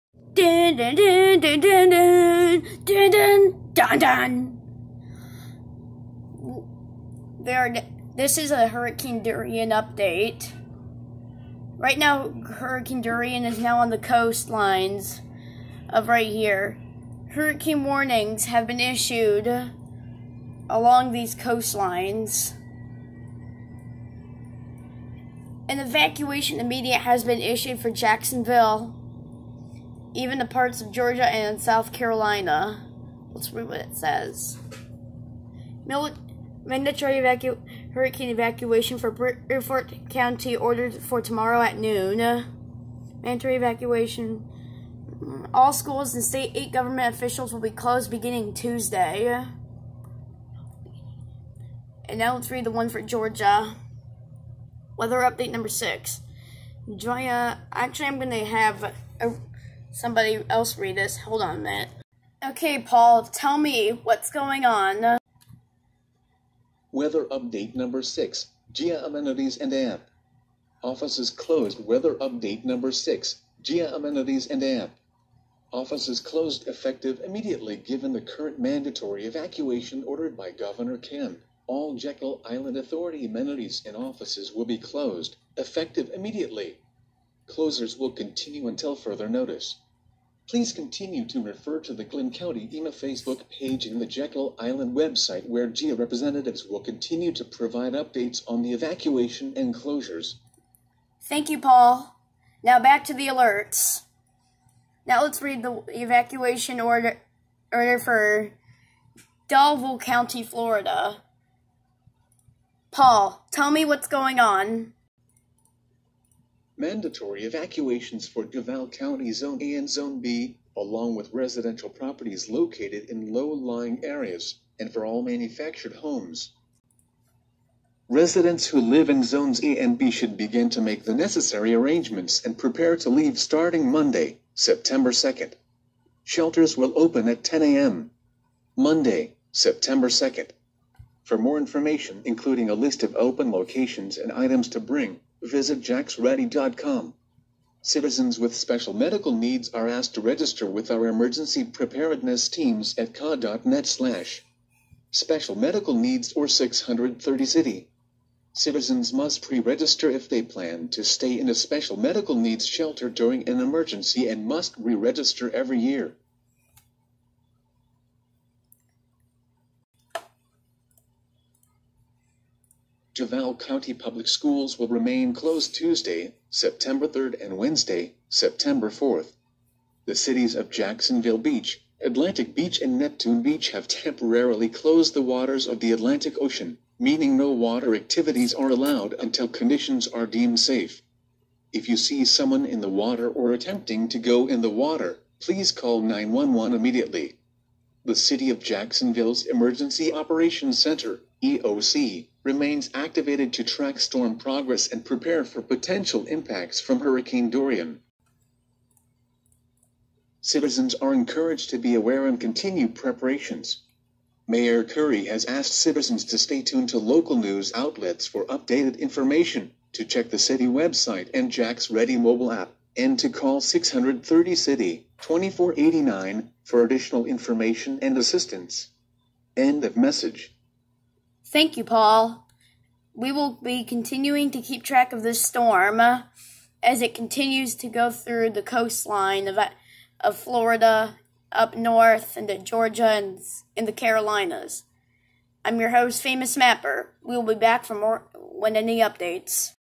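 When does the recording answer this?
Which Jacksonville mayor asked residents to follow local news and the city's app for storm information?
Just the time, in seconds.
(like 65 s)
214 s.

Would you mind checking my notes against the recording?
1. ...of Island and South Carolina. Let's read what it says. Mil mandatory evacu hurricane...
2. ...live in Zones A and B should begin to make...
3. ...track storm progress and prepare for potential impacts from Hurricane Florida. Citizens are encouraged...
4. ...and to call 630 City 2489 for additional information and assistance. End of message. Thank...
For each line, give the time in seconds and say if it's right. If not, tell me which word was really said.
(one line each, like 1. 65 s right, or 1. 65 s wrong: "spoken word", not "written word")
1. 30 s wrong: "Georgia", not "Island"
2. 128 s right
3. 203 s wrong: "Dorian", not "Florida"
4. 222 s right.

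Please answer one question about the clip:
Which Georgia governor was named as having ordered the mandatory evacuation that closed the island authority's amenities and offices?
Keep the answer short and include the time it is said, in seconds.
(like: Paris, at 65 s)
Governor Kemp, at 80 s.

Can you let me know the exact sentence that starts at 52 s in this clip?
And now let's read the one for Georgia.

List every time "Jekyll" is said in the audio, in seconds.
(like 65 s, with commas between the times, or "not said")
81 s, 94 s.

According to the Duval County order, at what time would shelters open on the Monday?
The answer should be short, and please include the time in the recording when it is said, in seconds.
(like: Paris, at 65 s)
10 a.m., at 137 s.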